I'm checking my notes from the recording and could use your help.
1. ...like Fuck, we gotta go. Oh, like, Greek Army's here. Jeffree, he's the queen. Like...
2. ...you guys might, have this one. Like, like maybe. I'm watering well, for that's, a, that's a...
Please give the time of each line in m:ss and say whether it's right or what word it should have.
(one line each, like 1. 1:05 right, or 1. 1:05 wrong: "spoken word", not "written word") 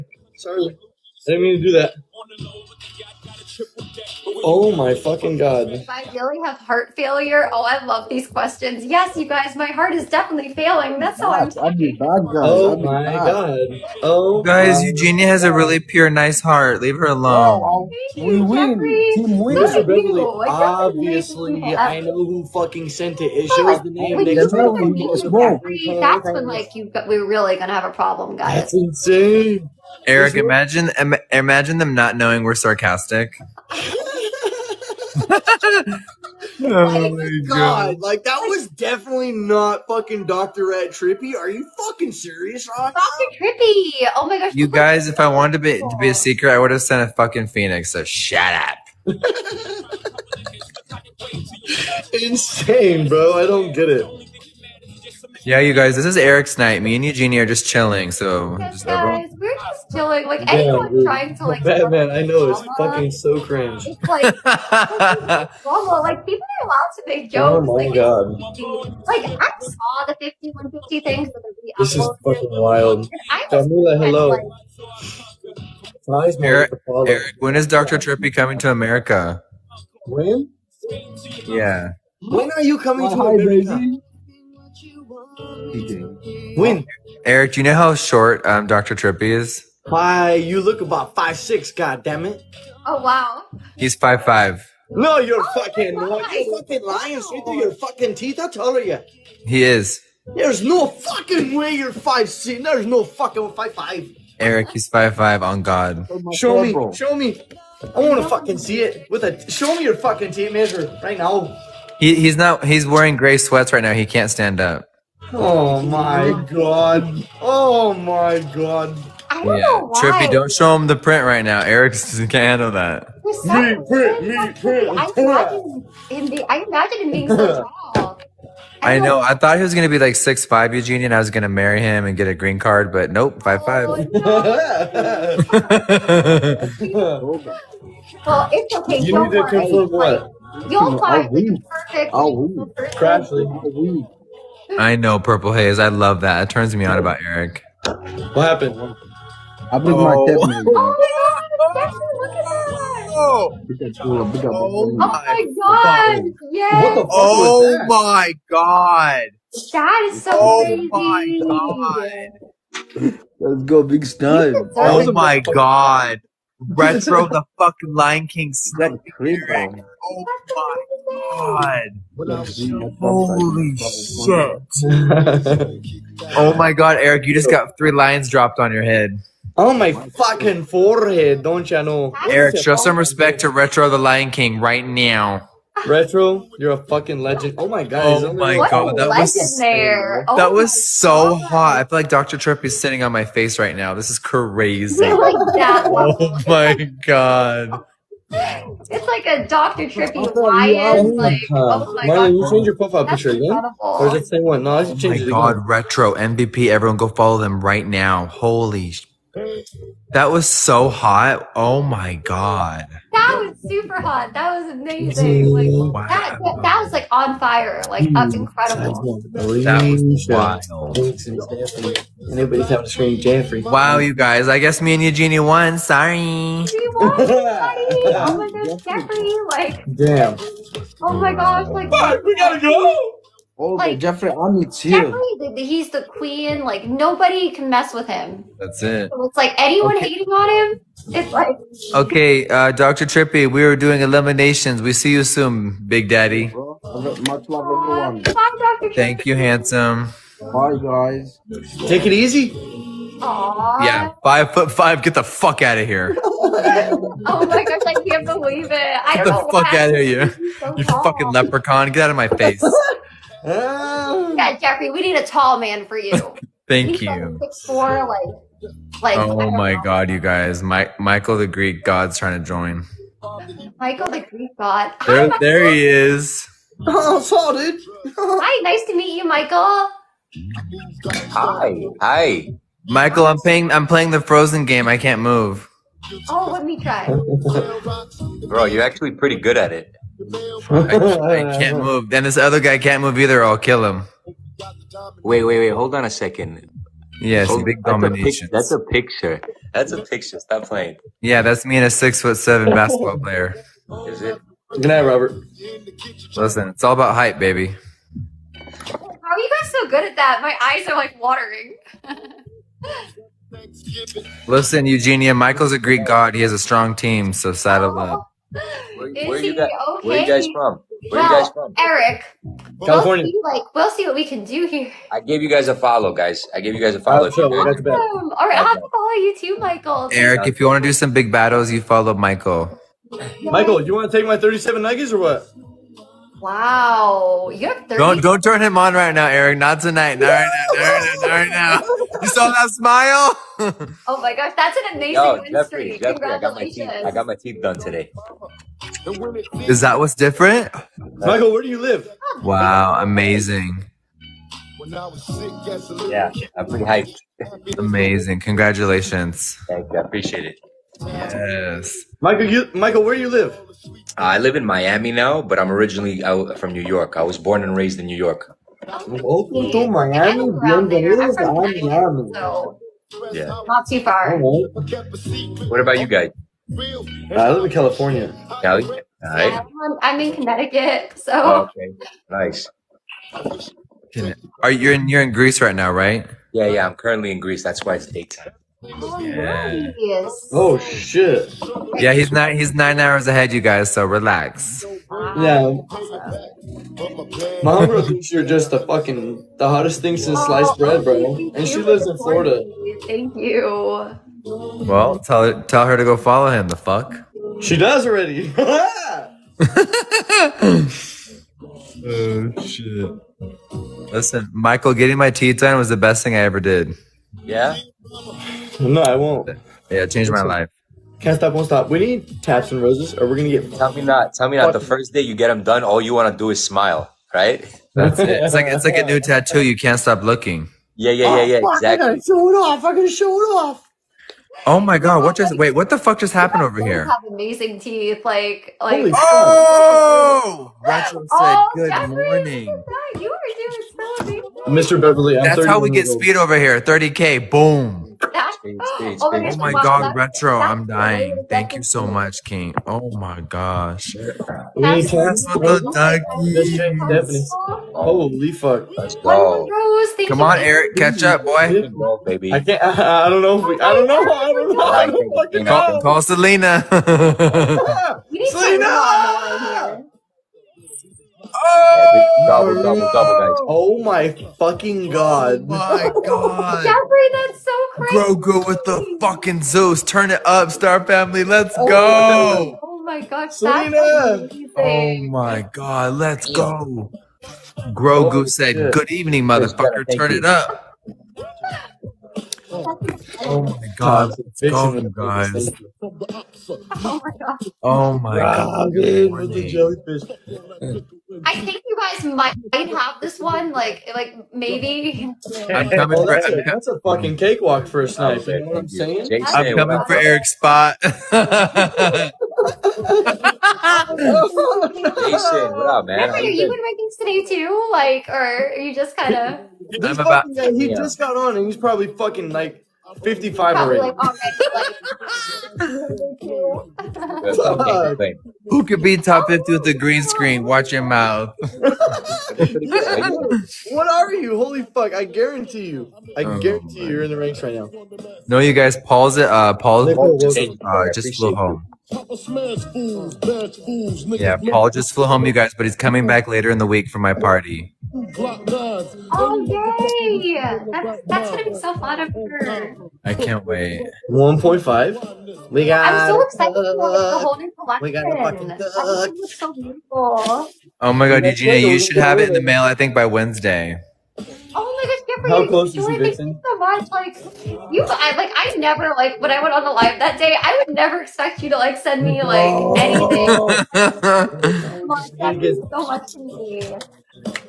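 1. 3:51 wrong: "Jeffree", not "Greek"
2. 8:21 wrong: "coming", not "watering".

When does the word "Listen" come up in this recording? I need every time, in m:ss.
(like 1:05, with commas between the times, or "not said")
5:06, 5:14, 6:54.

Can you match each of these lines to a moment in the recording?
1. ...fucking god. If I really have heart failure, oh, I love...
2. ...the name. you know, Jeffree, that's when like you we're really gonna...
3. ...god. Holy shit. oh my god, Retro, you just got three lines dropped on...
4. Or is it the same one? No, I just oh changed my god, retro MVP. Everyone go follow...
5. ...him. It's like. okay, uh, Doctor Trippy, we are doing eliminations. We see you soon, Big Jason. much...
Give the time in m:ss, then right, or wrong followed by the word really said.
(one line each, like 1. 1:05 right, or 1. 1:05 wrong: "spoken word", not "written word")
1. 0:04 right
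2. 0:23 right
3. 2:51 wrong: "Eric", not "Retro"
4. 3:23 right
5. 4:00 wrong: "Daddy", not "Jason".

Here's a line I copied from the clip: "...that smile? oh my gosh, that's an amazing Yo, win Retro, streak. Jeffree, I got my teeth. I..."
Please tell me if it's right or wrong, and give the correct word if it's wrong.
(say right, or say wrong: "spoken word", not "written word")
wrong: "Jeffree", not "Retro".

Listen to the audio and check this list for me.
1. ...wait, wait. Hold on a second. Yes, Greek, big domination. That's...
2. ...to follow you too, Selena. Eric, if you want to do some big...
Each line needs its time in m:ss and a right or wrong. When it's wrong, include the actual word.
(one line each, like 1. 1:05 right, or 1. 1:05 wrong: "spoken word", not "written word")
1. 4:55 wrong: "Hold", not "Greek"
2. 5:28 wrong: "Michael", not "Selena".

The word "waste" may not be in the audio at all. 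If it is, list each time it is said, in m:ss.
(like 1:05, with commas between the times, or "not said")
not said.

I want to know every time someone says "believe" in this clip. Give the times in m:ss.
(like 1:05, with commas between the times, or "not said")
2:29, 4:18.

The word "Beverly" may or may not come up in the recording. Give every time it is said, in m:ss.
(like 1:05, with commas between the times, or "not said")
0:19, 7:25.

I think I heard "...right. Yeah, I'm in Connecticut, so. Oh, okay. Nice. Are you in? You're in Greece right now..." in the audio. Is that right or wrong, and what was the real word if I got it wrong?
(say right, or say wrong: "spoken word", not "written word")
right.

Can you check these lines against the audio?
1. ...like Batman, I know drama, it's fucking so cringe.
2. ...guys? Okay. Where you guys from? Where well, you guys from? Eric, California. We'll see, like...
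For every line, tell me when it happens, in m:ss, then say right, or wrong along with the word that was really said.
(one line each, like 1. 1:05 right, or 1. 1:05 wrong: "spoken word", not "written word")
1. 1:01 right
2. 5:19 right.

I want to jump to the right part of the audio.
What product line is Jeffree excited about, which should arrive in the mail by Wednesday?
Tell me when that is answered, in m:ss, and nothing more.
9:17.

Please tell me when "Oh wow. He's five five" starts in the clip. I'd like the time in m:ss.
1:32.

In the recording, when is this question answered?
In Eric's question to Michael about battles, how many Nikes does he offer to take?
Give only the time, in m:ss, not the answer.
5:34.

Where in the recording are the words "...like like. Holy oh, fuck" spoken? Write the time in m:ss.
7:18.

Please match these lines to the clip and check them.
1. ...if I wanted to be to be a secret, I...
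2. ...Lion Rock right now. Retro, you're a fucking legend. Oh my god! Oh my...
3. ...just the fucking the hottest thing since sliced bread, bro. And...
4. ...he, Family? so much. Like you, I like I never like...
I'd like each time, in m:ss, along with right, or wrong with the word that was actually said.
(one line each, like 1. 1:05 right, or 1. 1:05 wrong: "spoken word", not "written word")
1. 0:45 right
2. 3:03 wrong: "King", not "Rock"
3. 6:38 right
4. 9:26 wrong: "Vixen", not "Family".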